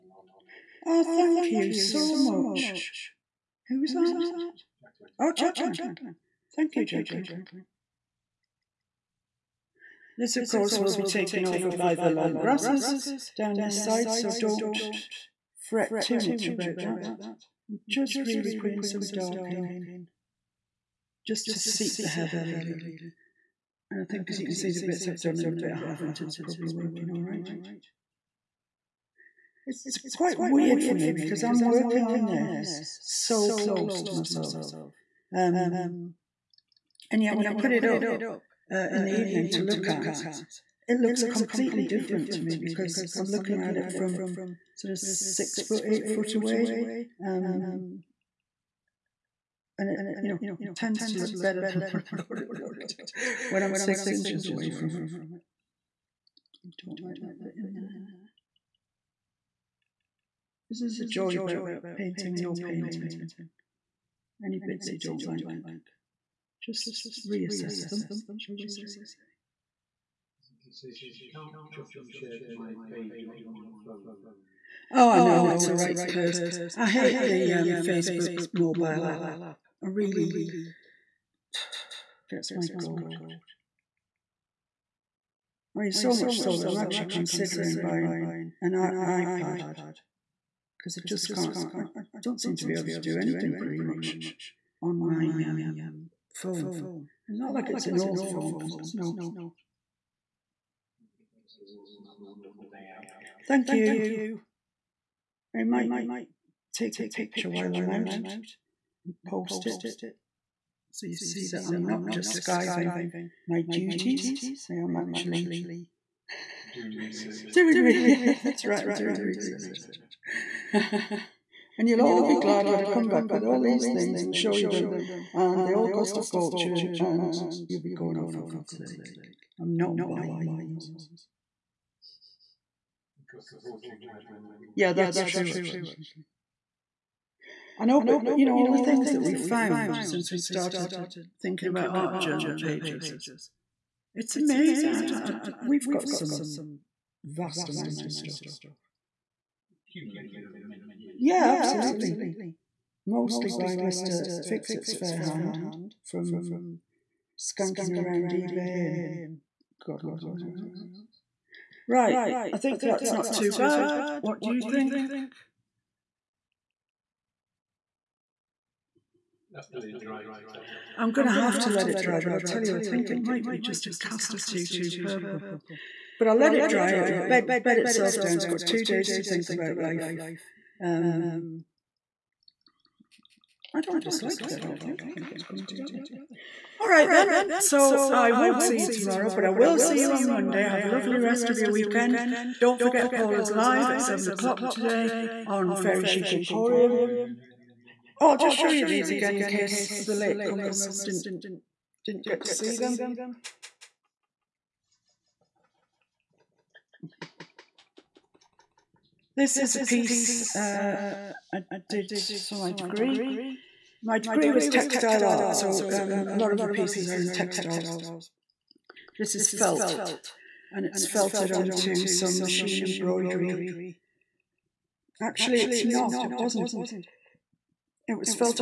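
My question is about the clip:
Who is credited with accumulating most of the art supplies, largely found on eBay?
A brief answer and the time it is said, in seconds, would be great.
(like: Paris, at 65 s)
Mr. Fixit, at 153 s.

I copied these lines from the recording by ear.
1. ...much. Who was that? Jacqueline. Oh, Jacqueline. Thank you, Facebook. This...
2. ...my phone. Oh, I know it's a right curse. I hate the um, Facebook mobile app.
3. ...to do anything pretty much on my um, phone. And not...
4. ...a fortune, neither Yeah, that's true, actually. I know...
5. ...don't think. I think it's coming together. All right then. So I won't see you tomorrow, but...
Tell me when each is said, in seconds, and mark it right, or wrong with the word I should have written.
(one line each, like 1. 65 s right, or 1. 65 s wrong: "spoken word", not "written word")
1. 2 s wrong: "Jacqueline", not "Facebook"
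2. 73 s right
3. 92 s right
4. 133 s right
5. 184 s right.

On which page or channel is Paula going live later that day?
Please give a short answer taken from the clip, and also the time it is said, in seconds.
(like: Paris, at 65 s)
Fairy Chic Emporium, at 195 s.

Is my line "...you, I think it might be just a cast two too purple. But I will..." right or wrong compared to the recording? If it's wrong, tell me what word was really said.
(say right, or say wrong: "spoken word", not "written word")
right.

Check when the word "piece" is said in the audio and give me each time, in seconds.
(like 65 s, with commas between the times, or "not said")
209 s, 216 s.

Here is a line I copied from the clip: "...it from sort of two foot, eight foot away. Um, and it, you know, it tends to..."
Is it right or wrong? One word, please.
wrong.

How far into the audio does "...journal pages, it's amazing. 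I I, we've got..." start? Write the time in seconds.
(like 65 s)
142 s.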